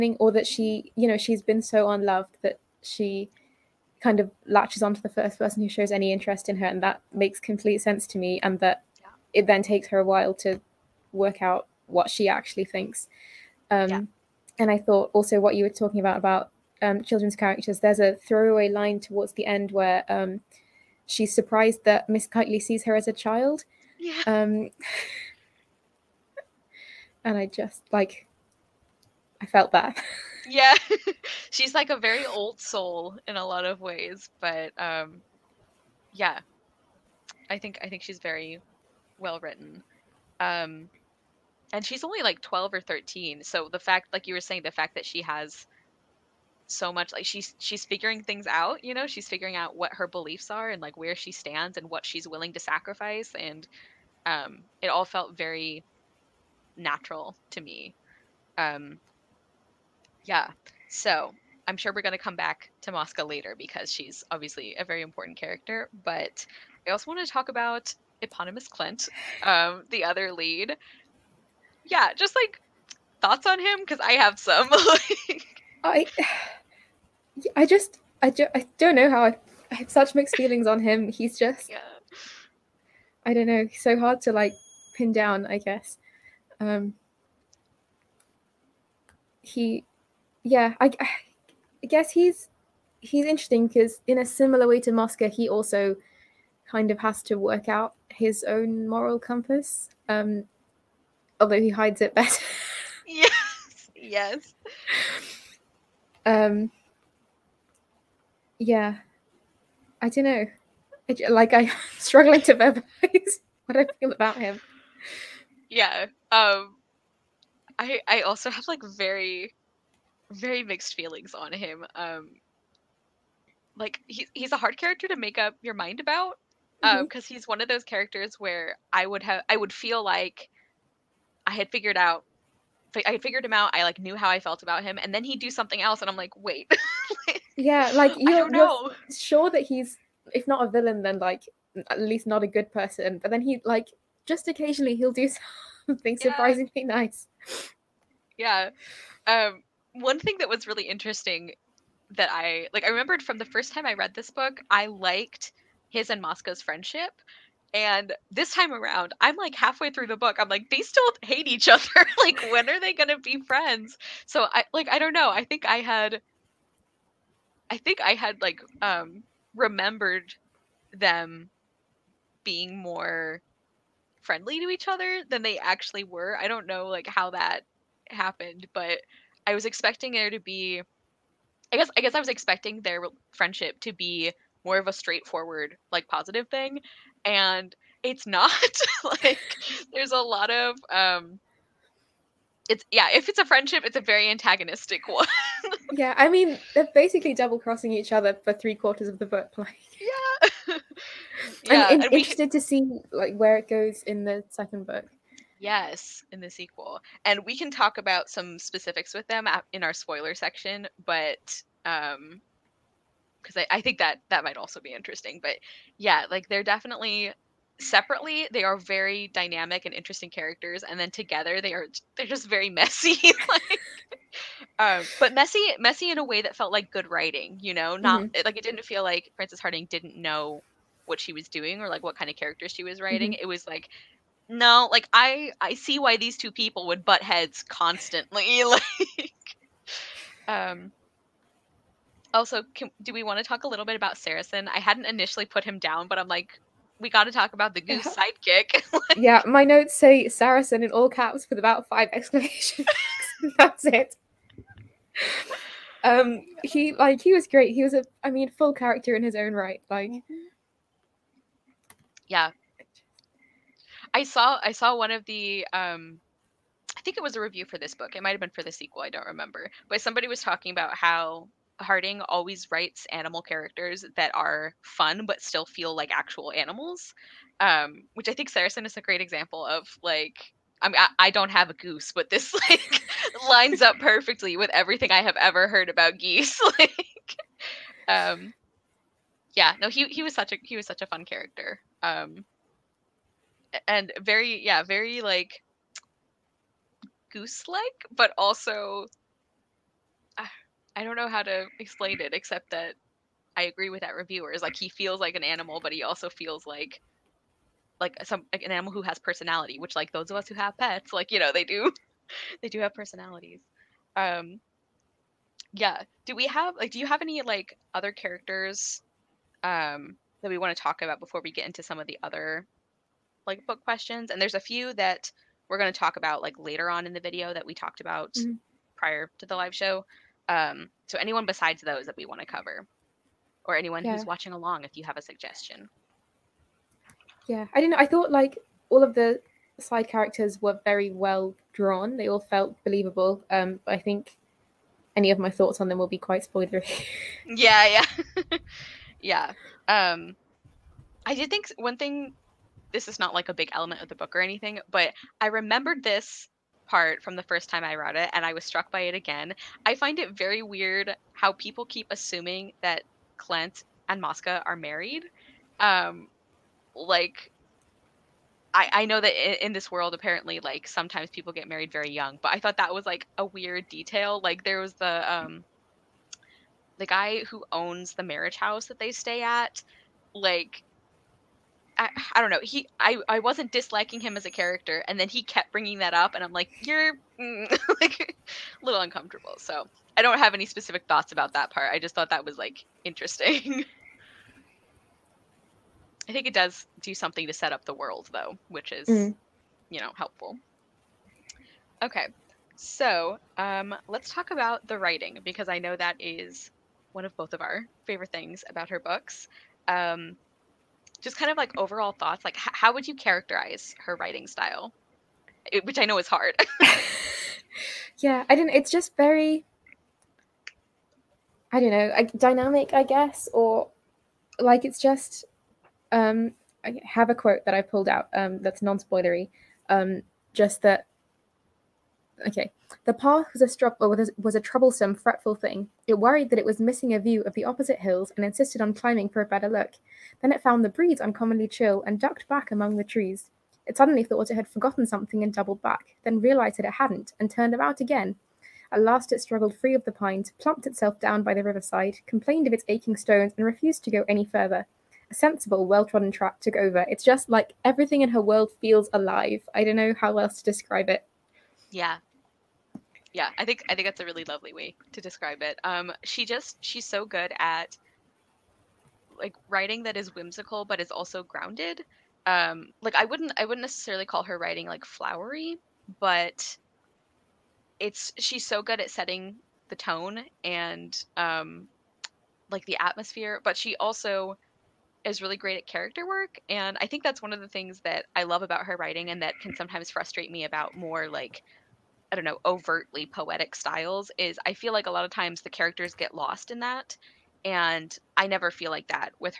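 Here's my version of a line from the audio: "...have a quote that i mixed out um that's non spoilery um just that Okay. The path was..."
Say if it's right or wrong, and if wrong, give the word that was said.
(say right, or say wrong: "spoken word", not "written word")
wrong: "pulled", not "mixed".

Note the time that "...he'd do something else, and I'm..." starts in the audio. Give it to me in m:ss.
2:15.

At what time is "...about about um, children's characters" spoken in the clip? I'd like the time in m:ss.
0:15.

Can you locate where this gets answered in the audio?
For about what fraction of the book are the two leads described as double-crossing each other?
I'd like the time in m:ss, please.
3:18.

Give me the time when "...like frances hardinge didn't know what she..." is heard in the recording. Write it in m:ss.
3:49.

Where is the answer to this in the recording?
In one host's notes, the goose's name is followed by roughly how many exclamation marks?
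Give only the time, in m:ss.
4:11.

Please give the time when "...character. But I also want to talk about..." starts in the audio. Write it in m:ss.
1:05.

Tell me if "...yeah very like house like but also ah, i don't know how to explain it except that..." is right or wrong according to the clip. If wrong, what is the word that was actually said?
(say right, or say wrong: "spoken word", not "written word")
wrong: "goose", not "house".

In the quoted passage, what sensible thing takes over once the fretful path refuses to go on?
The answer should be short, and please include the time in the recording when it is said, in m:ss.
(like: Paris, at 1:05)
well trodden track, at 7:35.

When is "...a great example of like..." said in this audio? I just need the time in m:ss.
4:38.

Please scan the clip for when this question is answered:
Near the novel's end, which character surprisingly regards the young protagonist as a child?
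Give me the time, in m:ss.
0:22.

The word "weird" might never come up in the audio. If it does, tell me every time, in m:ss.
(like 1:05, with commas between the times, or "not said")
6:00, 6:13.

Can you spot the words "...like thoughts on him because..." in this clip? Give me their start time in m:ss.
1:12.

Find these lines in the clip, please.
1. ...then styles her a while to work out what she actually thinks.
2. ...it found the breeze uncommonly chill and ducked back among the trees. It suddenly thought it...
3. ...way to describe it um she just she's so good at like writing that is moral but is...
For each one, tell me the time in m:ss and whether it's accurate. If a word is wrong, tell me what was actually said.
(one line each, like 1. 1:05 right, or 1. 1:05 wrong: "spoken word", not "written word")
1. 0:09 wrong: "takes", not "styles"
2. 7:20 right
3. 7:44 wrong: "whimsical", not "moral".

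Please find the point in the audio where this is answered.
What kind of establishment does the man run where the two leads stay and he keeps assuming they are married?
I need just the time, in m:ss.
6:18.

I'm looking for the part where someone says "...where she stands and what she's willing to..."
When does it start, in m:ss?
0:50.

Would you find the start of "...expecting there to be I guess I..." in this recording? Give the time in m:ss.
2:59.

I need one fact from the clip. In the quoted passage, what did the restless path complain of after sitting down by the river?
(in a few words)
aching stones.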